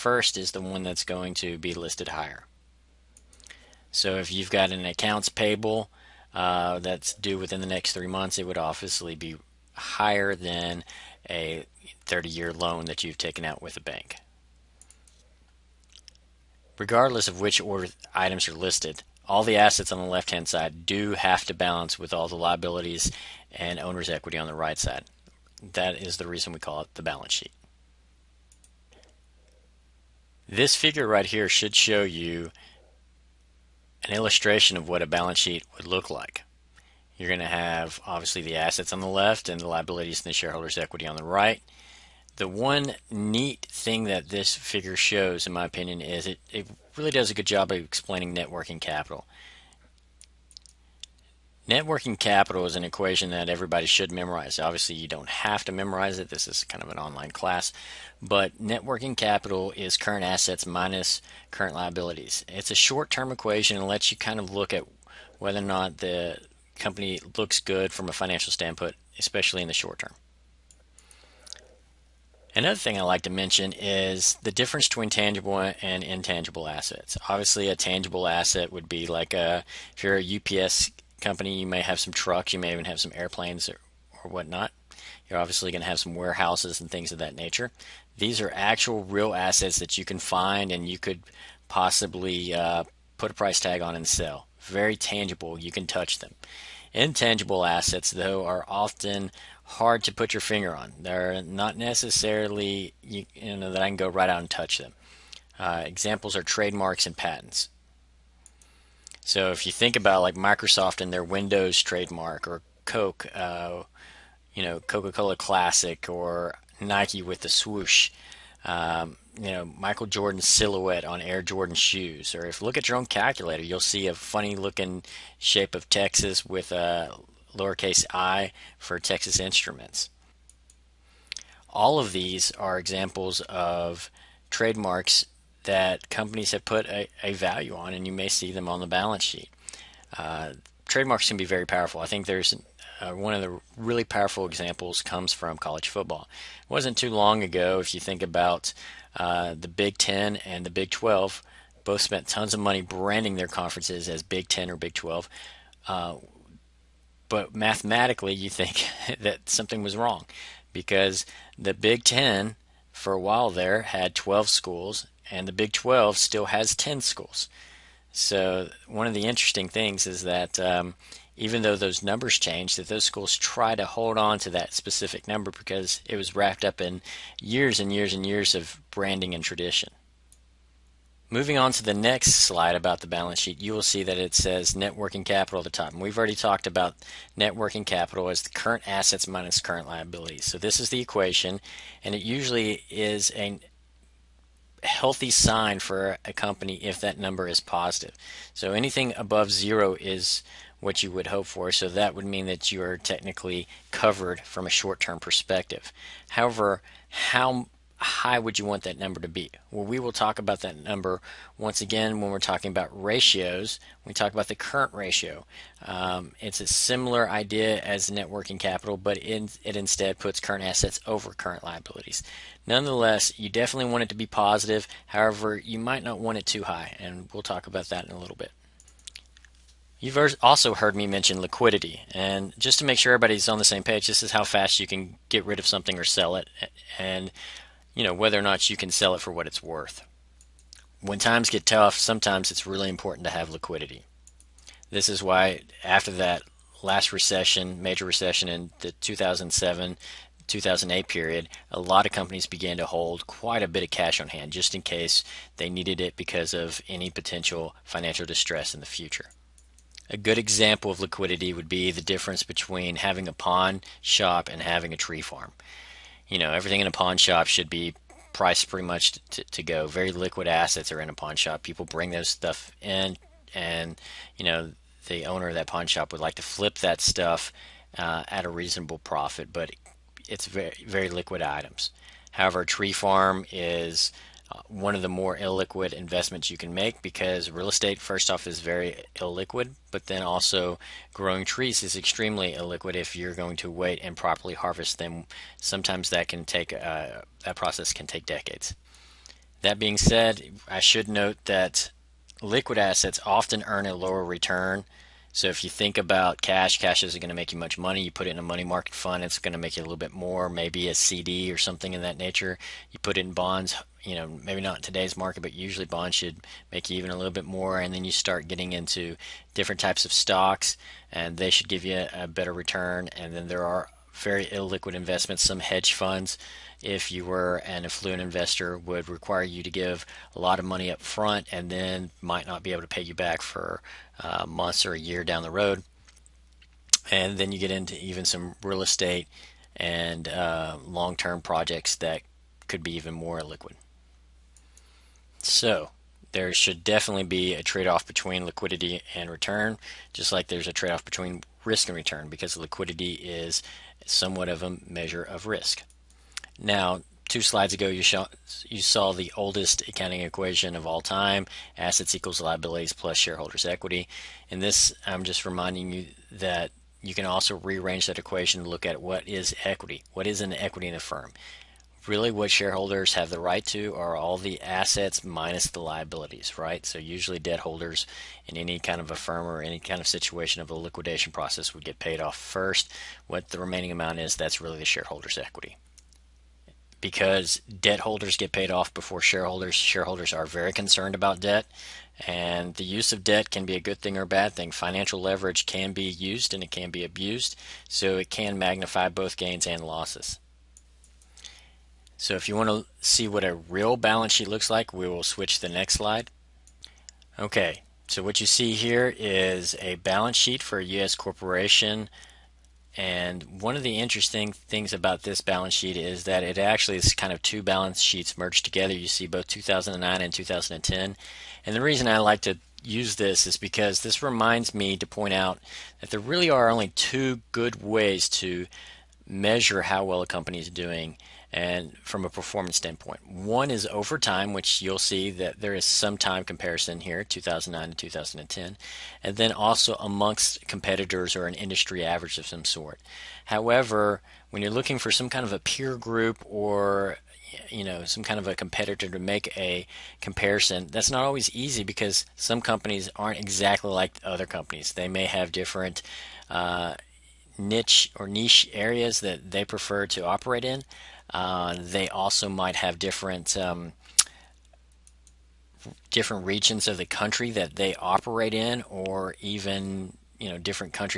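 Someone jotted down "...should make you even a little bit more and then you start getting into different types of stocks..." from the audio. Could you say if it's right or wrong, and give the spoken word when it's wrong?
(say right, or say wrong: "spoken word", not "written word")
right.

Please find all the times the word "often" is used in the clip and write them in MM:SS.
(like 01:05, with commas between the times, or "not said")
01:38, 05:03.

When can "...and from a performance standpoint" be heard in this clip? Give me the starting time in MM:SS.
07:11.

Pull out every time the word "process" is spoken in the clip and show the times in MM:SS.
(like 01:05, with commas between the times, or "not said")
04:57, 06:21.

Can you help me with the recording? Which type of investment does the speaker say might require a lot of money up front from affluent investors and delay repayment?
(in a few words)
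hedge funds.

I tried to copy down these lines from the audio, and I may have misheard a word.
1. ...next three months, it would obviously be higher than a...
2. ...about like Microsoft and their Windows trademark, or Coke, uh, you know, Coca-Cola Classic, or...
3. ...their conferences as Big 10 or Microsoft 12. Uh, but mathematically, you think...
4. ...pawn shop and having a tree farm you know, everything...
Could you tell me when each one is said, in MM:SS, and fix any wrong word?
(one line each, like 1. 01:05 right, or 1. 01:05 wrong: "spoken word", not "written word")
1. 00:07 right
2. 01:49 right
3. 02:33 wrong: "Big", not "Microsoft"
4. 04:23 right.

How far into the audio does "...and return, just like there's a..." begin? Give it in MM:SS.
05:49.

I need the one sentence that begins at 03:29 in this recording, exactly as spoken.
Well, we will talk about that number once again when we're talking about ratios.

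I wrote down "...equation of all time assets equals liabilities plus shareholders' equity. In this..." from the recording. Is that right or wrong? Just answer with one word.
right.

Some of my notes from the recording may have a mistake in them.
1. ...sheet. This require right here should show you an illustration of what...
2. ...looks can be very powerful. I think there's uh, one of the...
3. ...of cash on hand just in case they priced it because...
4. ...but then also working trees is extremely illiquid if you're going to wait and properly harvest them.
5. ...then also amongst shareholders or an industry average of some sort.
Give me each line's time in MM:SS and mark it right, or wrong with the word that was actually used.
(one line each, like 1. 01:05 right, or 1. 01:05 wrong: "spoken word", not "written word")
1. 00:27 wrong: "figure", not "require"
2. 02:20 wrong: "trademarks", not "looks"
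3. 04:13 wrong: "needed", not "priced"
4. 04:49 wrong: "growing", not "working"
5. 07:19 wrong: "competitors", not "shareholders".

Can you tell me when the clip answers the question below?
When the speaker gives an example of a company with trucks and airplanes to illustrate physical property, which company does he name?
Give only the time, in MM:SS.
01:20.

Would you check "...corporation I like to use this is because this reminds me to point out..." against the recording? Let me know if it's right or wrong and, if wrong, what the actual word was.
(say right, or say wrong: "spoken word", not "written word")
wrong: "reason", not "corporation".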